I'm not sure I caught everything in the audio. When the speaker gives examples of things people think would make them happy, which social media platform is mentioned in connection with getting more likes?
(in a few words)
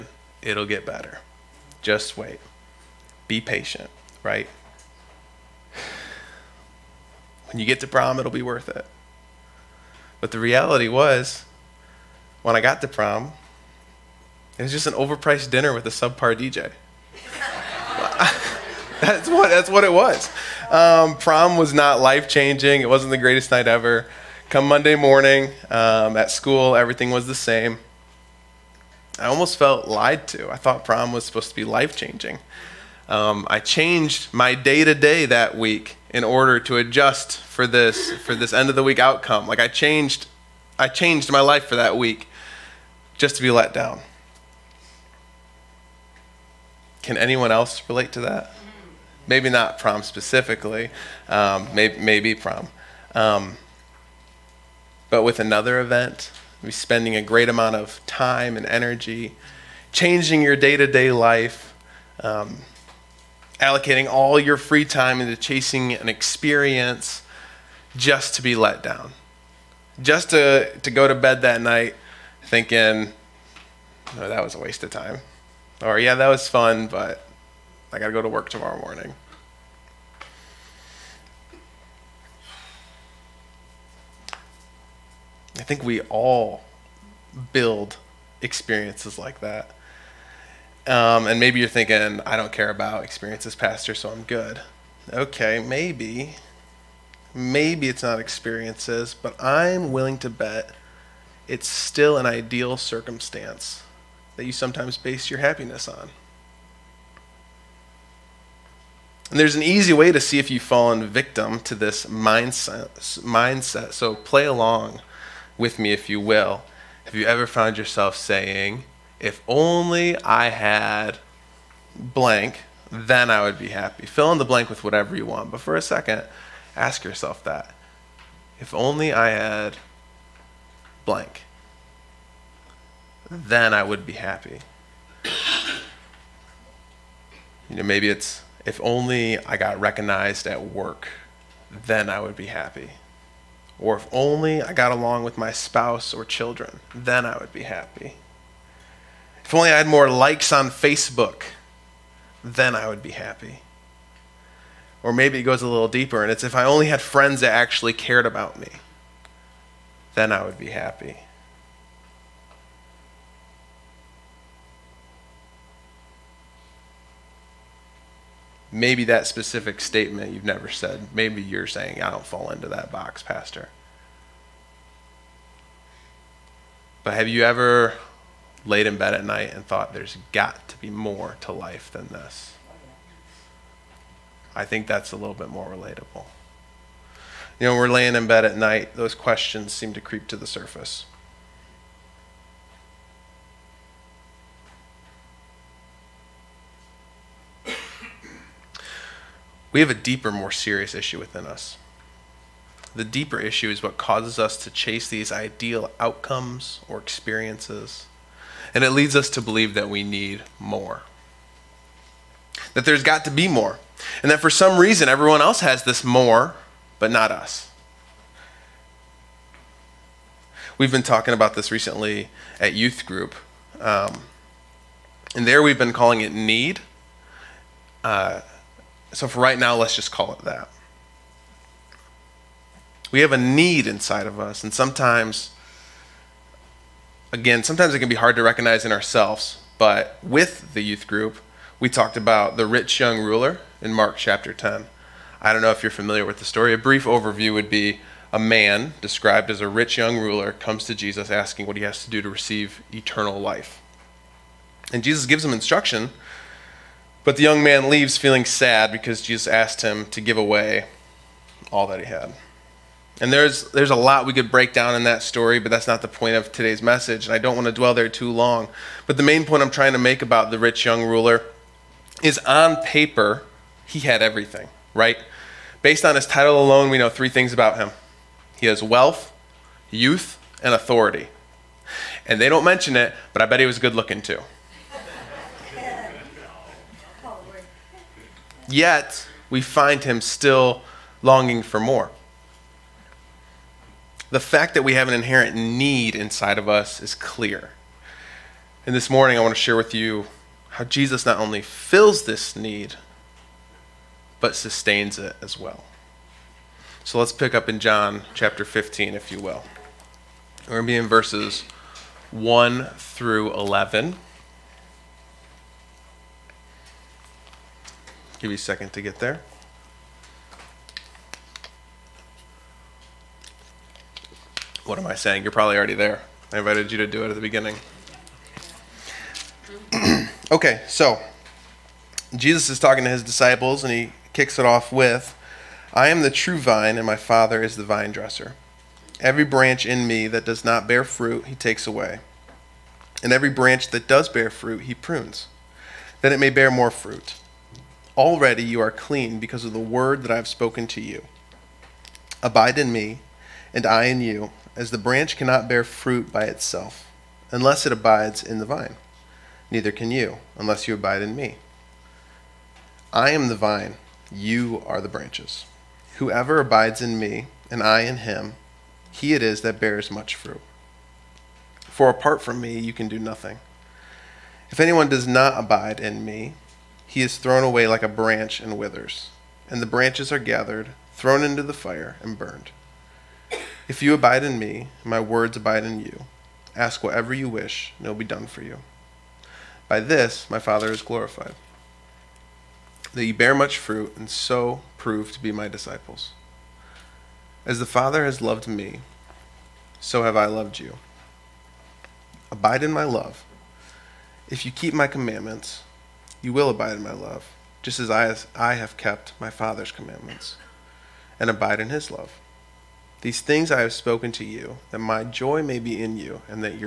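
Facebook.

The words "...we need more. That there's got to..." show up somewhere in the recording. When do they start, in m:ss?
3:29.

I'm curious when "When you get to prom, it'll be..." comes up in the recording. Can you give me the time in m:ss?
0:07.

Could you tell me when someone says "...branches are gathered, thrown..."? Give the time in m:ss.
6:19.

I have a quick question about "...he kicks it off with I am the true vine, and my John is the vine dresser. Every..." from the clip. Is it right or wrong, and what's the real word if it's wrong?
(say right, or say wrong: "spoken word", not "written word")
wrong: "Father", not "John".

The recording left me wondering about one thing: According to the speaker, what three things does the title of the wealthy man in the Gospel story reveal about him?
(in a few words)
wealth, youth, and authority.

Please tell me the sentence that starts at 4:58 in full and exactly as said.
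And this morning, I want to share with you how Jesus not only fills this need, but sustains it as well.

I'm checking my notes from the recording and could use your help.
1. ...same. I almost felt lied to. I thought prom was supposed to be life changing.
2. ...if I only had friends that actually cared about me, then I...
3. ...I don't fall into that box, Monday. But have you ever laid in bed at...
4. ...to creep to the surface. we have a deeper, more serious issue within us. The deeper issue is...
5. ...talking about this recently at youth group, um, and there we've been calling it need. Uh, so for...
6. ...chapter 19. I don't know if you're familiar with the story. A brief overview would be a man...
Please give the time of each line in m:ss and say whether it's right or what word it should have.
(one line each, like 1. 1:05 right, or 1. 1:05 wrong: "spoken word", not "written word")
1. 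0:27 right
2. 2:36 right
3. 2:52 wrong: "Pastor", not "Monday"
4. 3:09 right
5. 3:41 right
6. 4:04 wrong: "10", not "19".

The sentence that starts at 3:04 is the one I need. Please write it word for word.
I think that's a little bit more relatable.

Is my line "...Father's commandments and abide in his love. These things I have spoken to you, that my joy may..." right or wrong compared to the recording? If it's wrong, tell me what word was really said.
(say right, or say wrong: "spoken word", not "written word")
right.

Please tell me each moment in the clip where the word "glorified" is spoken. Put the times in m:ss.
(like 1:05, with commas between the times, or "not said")
6:31.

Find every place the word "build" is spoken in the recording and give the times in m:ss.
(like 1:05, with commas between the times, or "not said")
1:27.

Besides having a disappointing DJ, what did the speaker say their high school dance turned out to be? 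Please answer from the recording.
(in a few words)
an overpriced dinner.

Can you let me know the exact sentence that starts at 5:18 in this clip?
Give you a second to get there.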